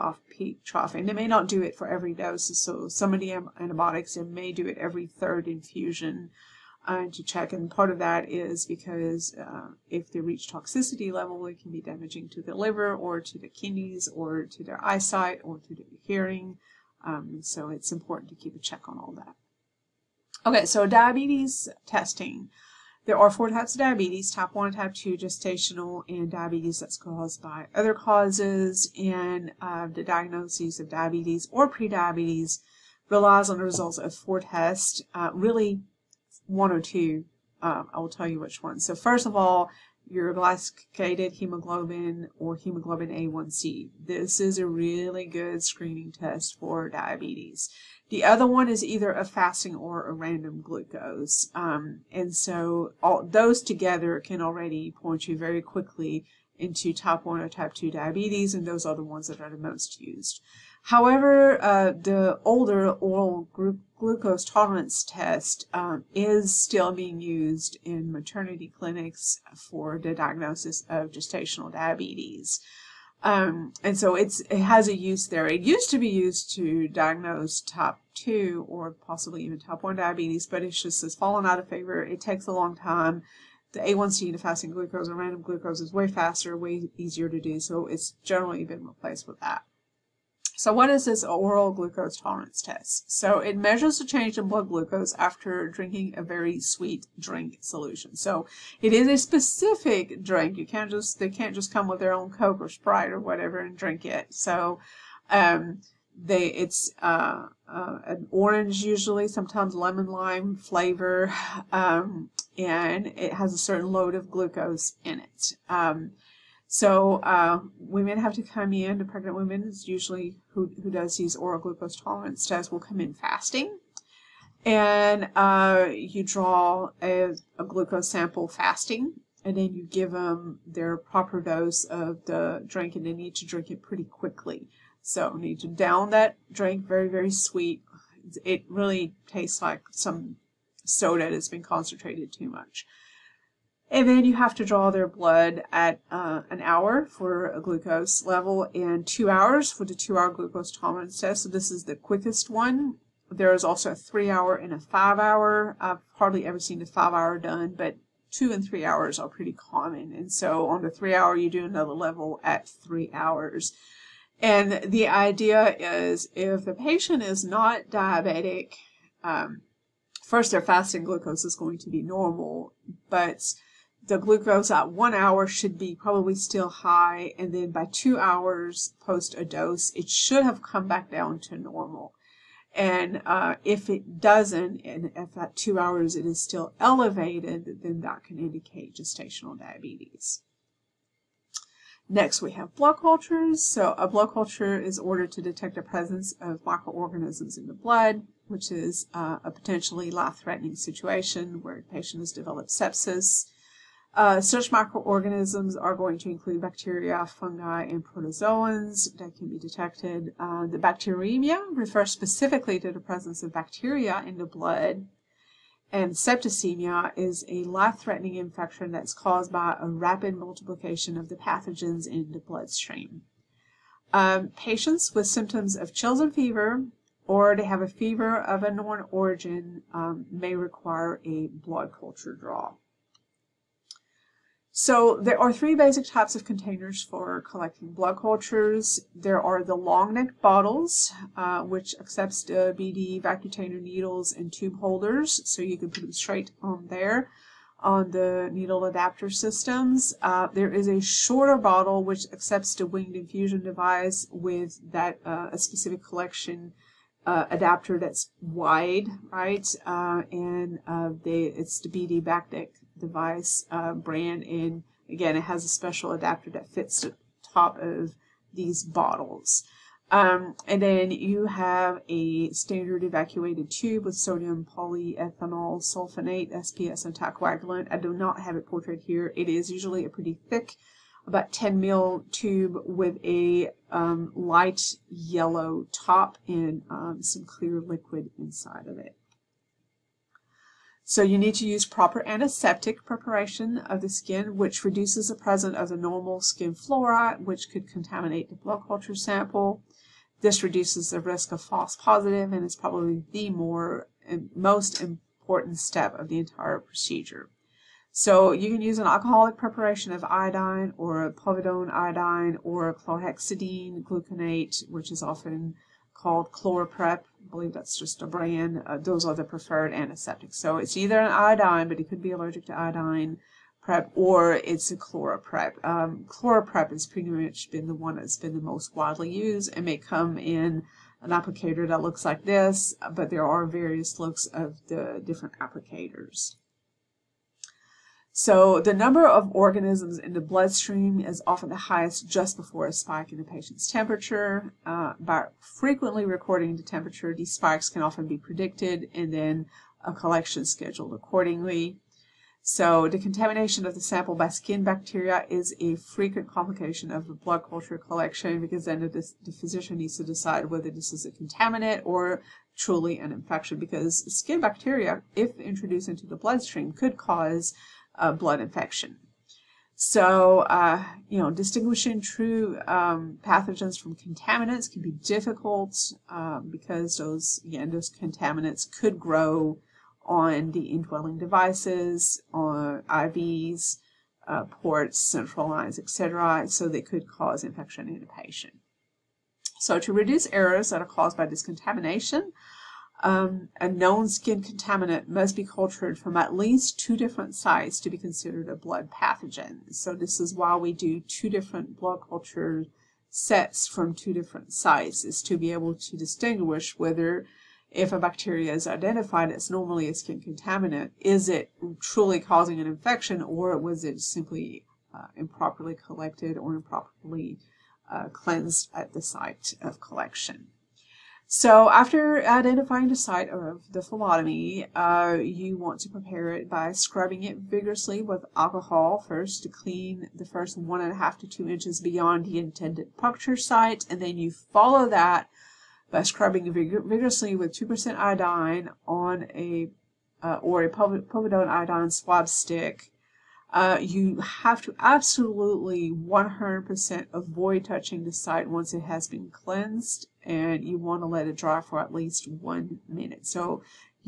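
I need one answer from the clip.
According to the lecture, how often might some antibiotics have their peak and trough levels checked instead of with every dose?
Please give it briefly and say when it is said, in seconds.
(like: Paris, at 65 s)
Every third infusion, at 4 s.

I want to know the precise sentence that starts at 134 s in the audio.
So need to down that drink, very, very sweet.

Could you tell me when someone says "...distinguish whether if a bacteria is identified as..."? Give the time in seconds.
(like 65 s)
406 s.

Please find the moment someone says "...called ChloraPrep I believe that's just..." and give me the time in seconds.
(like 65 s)
316 s.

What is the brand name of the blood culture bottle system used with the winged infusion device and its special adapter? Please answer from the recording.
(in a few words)
BD Bactec.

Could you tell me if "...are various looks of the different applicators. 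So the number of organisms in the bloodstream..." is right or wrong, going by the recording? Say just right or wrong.
right.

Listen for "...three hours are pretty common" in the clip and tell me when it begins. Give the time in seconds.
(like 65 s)
158 s.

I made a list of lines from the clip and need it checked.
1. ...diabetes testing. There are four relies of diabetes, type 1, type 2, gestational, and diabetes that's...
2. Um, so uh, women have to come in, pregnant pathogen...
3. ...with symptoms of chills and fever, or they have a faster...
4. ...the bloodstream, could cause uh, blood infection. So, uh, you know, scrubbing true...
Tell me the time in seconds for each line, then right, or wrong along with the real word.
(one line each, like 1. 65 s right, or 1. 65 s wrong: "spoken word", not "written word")
1. 20 s wrong: "types", not "relies"
2. 115 s wrong: "women", not "pathogen"
3. 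225 s wrong: "fever", not "faster"
4. 366 s wrong: "distinguishing", not "scrubbing".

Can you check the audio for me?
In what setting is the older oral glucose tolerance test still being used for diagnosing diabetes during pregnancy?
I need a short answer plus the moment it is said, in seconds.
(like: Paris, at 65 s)
Maternity clinics, at 68 s.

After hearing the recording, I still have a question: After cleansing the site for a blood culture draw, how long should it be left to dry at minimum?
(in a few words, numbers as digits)
1 minute.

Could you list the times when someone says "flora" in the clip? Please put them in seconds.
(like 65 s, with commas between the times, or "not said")
296 s.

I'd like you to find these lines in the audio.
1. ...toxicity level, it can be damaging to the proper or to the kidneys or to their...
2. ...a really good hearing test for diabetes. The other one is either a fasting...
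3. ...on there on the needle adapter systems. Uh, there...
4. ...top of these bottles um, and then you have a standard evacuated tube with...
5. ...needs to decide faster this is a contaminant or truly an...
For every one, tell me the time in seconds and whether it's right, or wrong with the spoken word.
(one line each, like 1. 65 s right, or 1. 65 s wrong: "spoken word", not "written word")
1. 10 s wrong: "liver", not "proper"
2. 44 s wrong: "screening", not "hearing"
3. 246 s right
4. 267 s right
5. 359 s wrong: "whether", not "faster".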